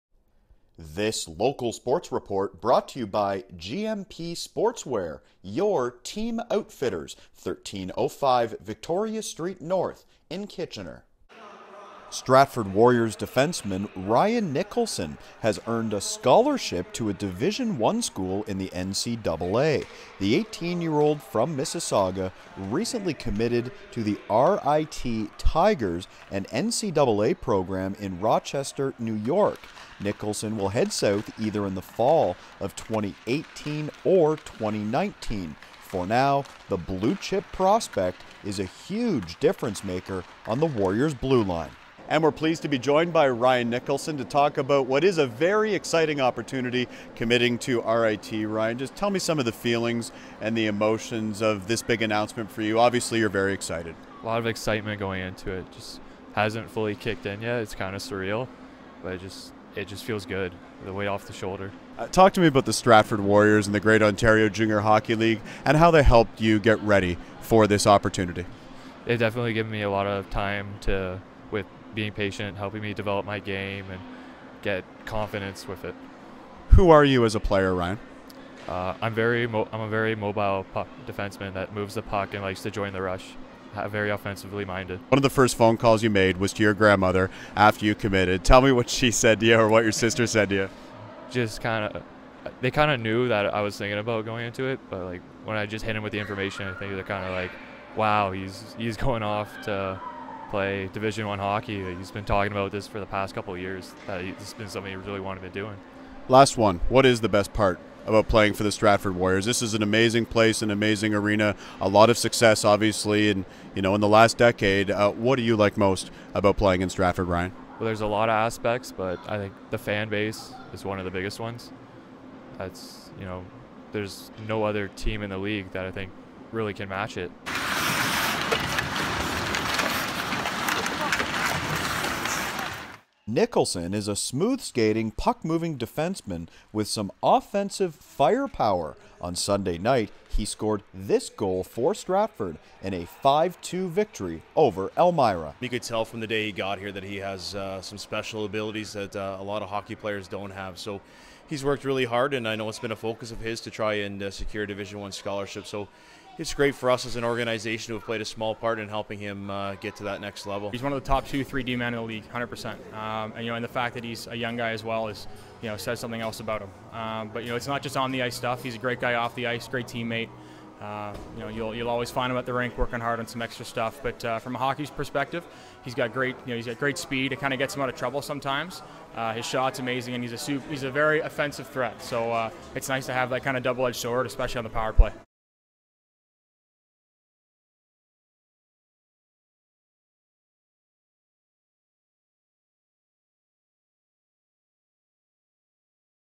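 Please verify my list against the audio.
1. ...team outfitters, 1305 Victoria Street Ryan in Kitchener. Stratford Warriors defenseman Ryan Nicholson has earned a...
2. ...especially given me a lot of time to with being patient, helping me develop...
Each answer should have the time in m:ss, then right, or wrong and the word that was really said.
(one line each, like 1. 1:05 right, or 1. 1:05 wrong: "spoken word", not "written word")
1. 0:05 wrong: "North", not "Ryan"
2. 1:09 wrong: "definitely", not "especially".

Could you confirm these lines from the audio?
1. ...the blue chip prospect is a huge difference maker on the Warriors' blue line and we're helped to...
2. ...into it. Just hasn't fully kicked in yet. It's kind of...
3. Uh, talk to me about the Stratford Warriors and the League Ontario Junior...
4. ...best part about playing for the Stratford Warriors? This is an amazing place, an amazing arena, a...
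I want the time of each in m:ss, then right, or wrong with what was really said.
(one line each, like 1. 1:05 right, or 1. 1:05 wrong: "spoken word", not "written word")
1. 0:36 wrong: "pleased", not "helped"
2. 0:55 right
3. 1:01 wrong: "Greater", not "League"
4. 1:47 right.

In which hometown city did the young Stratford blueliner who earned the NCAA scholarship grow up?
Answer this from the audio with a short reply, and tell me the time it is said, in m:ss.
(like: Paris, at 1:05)
Mississauga, at 0:21.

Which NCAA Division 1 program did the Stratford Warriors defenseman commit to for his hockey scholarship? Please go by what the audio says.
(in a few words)
RIT Tigers.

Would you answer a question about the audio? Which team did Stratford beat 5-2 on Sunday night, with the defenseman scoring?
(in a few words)
Elmira.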